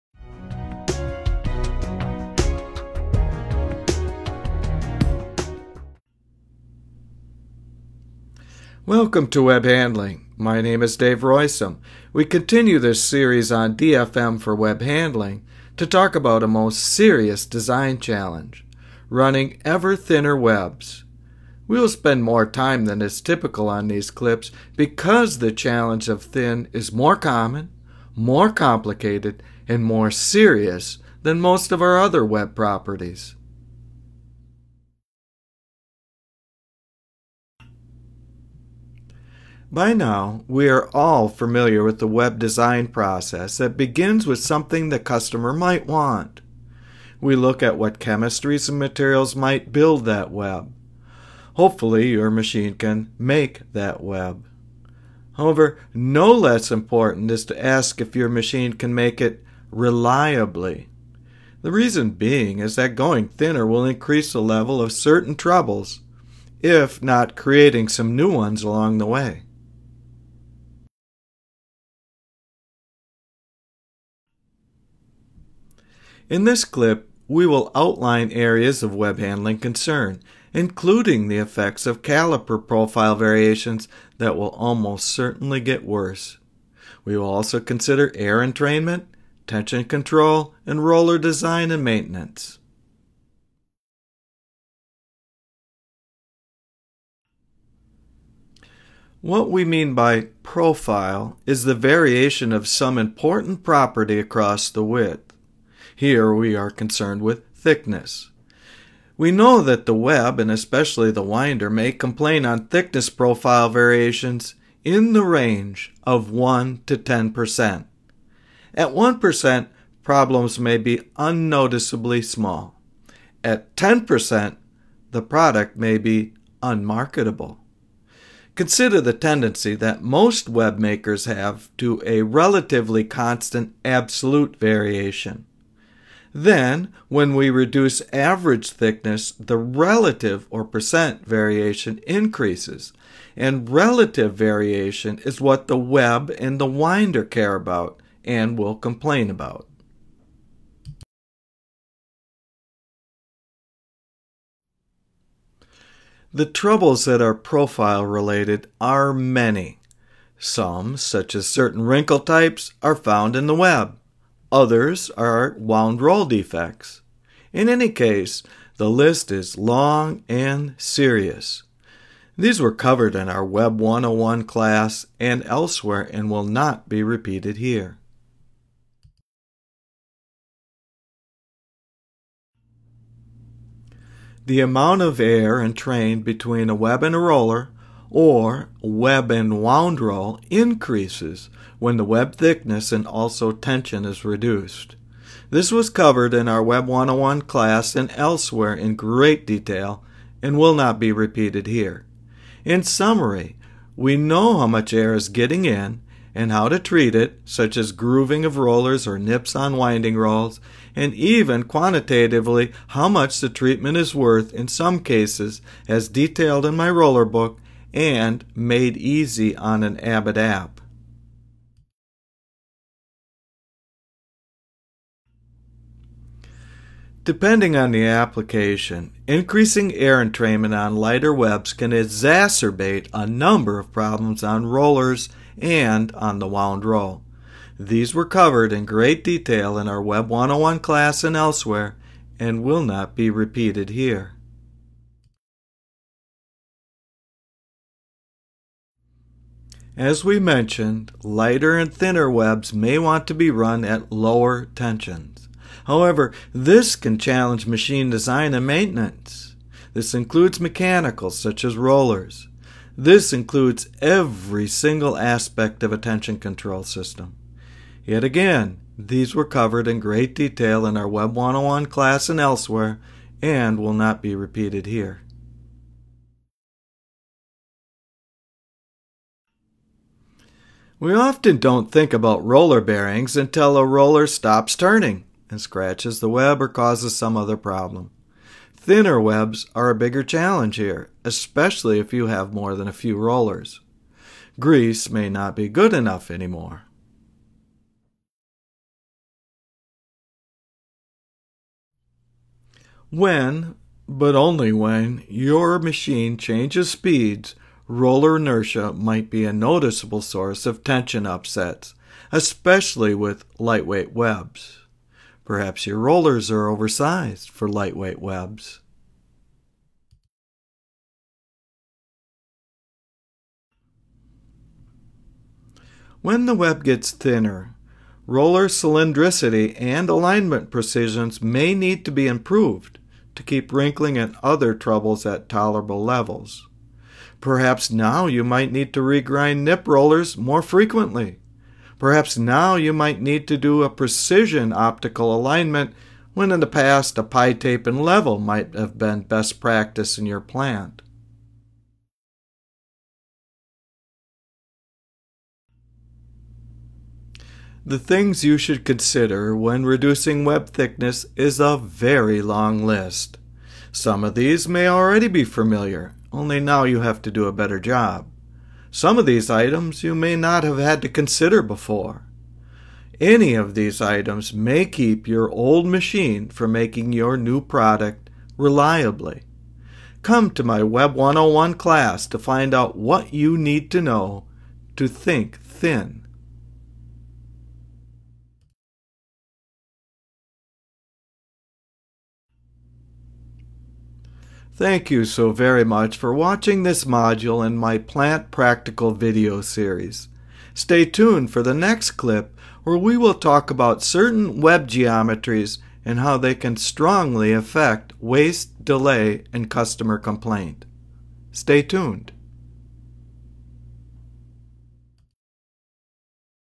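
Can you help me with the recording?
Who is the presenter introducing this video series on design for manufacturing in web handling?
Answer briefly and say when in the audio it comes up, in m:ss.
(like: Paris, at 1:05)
Dave Roisum, at 0:10.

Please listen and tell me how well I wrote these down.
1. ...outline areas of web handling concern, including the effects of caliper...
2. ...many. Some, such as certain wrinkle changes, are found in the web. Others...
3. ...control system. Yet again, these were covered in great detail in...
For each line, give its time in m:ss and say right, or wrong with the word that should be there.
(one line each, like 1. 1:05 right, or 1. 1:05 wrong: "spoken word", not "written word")
1. 1:17 right
2. 2:39 wrong: "types", not "changes"
3. 4:26 right.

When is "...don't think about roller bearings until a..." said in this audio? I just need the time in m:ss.
4:41.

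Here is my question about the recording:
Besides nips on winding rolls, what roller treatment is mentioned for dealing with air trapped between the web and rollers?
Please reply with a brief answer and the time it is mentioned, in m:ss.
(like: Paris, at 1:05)
grooving, at 3:27.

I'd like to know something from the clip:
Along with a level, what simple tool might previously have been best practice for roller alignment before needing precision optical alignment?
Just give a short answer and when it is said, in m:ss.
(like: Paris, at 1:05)
pi tape, at 5:47.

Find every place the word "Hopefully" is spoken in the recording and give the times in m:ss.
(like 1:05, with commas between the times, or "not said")
0:51.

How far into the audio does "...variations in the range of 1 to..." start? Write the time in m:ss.
1:53.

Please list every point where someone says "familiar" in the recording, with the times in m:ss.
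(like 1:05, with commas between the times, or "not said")
0:41, 6:05.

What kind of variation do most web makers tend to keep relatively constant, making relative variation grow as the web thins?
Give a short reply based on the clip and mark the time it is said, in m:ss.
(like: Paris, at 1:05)
absolute variation, at 2:13.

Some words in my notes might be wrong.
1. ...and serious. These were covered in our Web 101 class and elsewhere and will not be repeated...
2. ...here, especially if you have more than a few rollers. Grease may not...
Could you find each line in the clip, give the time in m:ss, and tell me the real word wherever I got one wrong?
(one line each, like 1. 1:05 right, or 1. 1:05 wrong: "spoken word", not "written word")
1. 2:50 right
2. 4:50 right.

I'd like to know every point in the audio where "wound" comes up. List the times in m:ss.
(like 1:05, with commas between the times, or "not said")
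2:45, 3:09, 3:56.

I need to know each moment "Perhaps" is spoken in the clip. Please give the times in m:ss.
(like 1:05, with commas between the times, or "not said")
5:15, 5:37, 5:41.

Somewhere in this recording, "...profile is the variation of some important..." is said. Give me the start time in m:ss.
1:40.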